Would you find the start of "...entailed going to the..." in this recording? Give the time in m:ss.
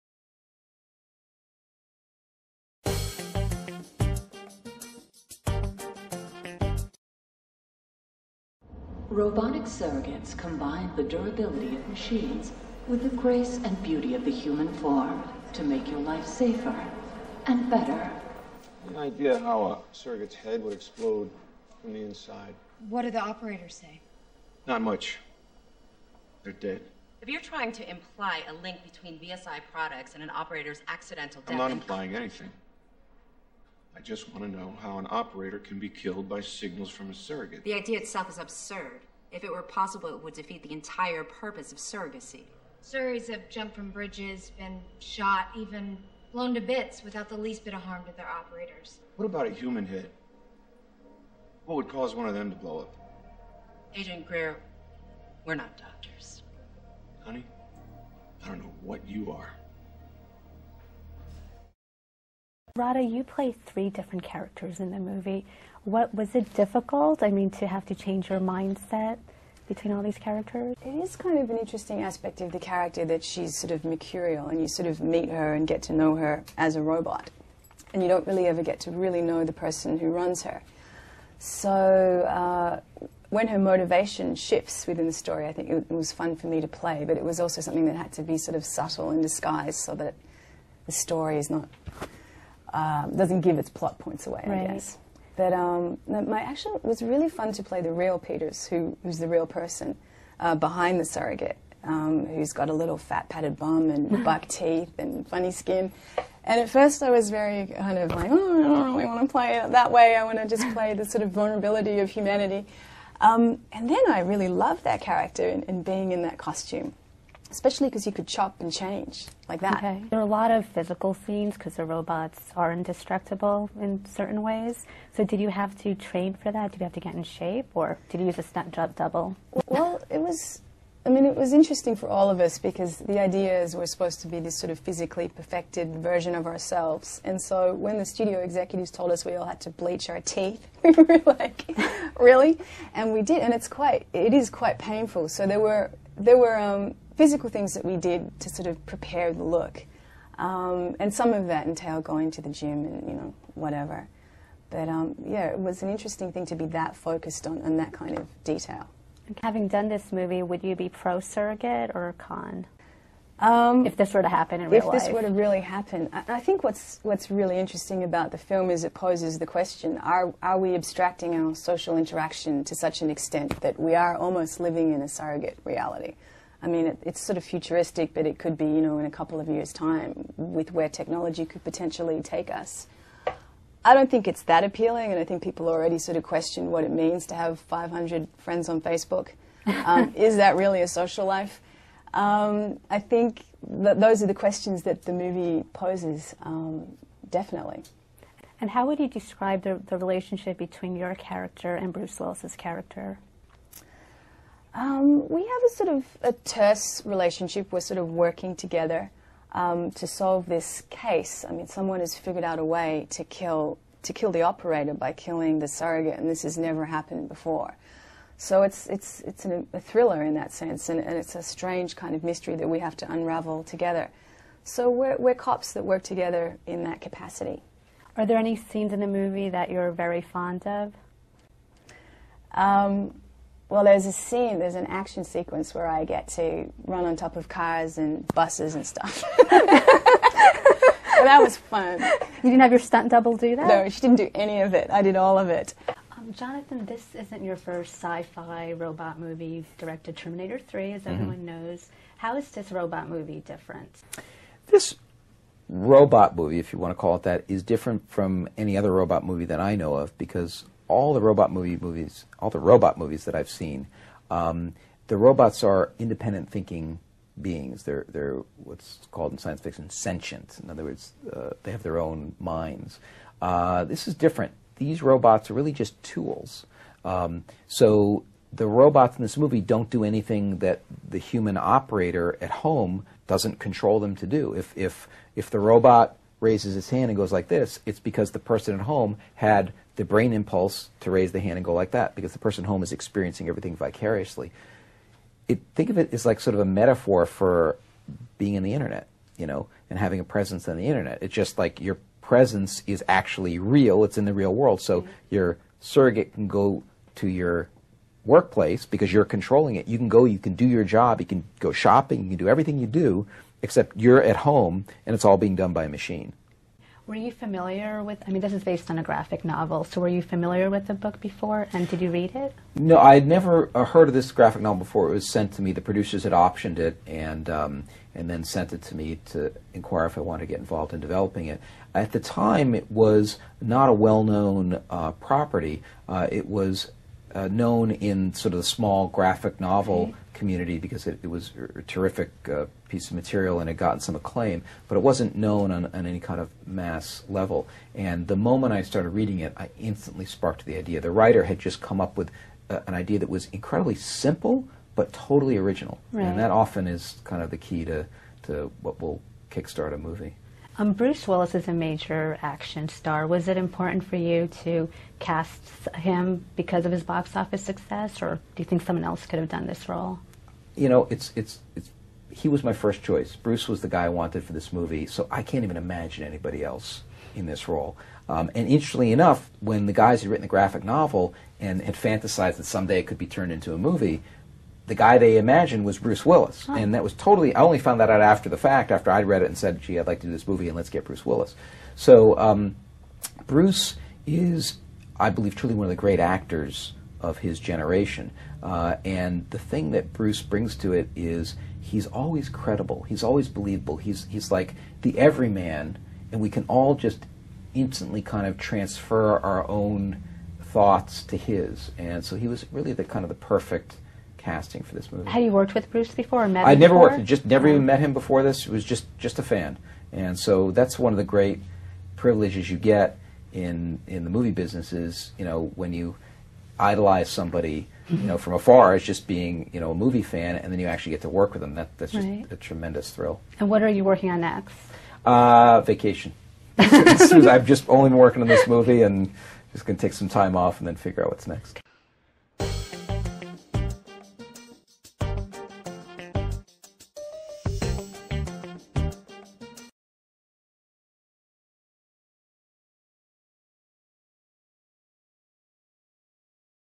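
2:31.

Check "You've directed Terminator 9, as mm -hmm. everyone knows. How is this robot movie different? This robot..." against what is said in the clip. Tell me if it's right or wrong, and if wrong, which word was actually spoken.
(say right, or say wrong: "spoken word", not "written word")
wrong: "3", not "9".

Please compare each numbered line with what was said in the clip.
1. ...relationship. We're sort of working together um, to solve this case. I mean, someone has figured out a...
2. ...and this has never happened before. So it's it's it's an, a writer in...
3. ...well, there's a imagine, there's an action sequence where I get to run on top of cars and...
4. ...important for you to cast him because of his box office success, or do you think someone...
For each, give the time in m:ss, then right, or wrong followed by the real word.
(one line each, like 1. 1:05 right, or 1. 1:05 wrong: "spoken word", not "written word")
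1. 3:27 right
2. 3:36 wrong: "thriller", not "writer"
3. 3:53 wrong: "scene", not "imagine"
4. 6:03 right.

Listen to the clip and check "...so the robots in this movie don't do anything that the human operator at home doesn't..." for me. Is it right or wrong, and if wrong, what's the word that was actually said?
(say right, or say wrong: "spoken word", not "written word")
right.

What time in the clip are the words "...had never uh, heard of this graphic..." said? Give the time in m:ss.
5:23.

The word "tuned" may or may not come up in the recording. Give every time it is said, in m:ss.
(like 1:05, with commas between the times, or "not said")
not said.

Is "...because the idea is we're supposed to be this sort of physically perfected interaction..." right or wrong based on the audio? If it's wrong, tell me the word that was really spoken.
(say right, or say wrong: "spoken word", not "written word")
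wrong: "version", not "interaction".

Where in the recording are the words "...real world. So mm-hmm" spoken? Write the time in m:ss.
5:04.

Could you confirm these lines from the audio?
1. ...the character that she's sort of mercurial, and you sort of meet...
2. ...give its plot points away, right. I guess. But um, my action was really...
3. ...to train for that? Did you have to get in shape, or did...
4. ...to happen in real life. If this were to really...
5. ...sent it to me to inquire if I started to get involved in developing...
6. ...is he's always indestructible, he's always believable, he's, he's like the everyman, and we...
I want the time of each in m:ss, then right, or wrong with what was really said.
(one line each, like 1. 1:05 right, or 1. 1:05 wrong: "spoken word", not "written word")
1. 1:12 right
2. 1:33 right
3. 2:05 right
4. 2:44 right
5. 5:28 wrong: "wanted", not "started"
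6. 6:41 wrong: "credible", not "indestructible".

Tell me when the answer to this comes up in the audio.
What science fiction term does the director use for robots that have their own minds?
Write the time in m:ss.
4:29.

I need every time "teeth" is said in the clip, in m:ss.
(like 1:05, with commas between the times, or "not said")
1:44, 2:20.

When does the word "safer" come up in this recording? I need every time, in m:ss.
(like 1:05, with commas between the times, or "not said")
0:16.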